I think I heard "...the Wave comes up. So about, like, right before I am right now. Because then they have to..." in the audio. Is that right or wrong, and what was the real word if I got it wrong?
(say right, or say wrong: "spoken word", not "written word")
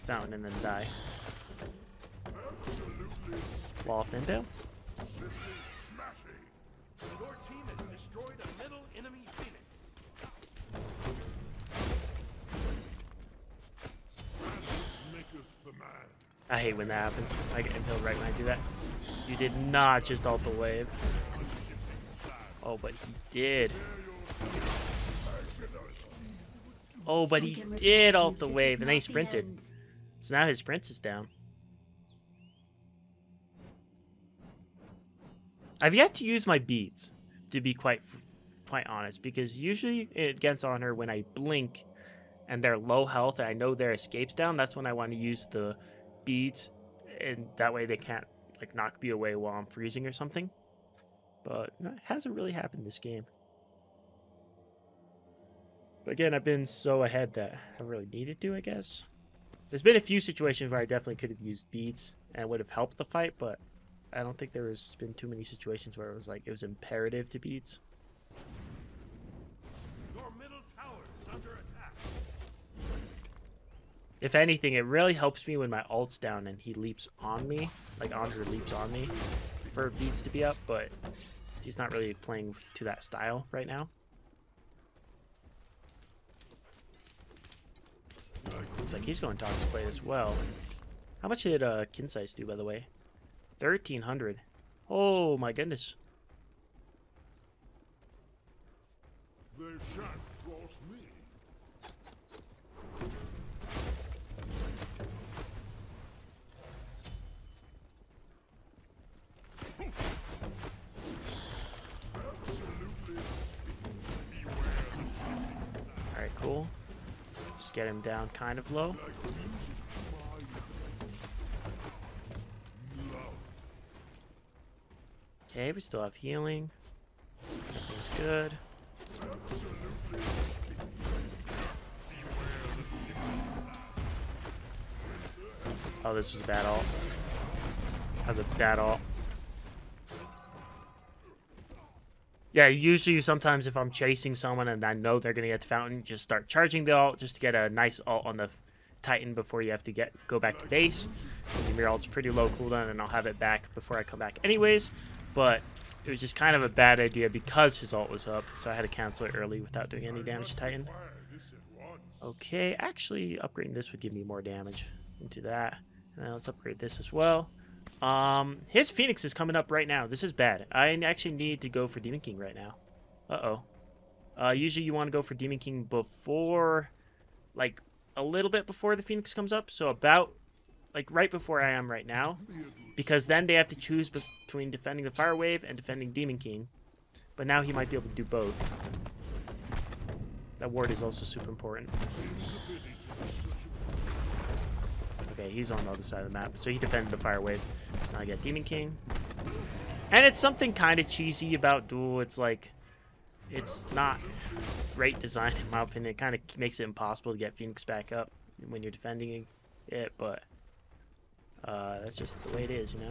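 wrong: "Phoenix", not "Wave".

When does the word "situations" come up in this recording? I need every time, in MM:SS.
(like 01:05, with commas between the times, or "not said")
01:00, 01:05.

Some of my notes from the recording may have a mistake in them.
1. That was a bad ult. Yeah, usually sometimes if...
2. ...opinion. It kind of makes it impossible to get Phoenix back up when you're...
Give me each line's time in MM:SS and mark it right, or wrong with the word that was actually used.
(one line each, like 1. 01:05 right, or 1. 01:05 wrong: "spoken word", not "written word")
1. 02:18 right
2. 03:25 right.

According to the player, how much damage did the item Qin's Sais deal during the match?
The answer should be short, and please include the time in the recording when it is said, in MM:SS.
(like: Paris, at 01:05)
1,300, at 01:33.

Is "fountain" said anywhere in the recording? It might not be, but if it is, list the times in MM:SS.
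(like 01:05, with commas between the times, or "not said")
00:00, 02:25.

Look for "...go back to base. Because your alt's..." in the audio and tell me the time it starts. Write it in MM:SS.
02:30.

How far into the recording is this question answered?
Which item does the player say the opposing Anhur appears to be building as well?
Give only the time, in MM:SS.
01:29.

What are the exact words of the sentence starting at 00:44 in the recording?
That's when I want to use the beads, and that way they can't like knock me away while I'm freezing or something.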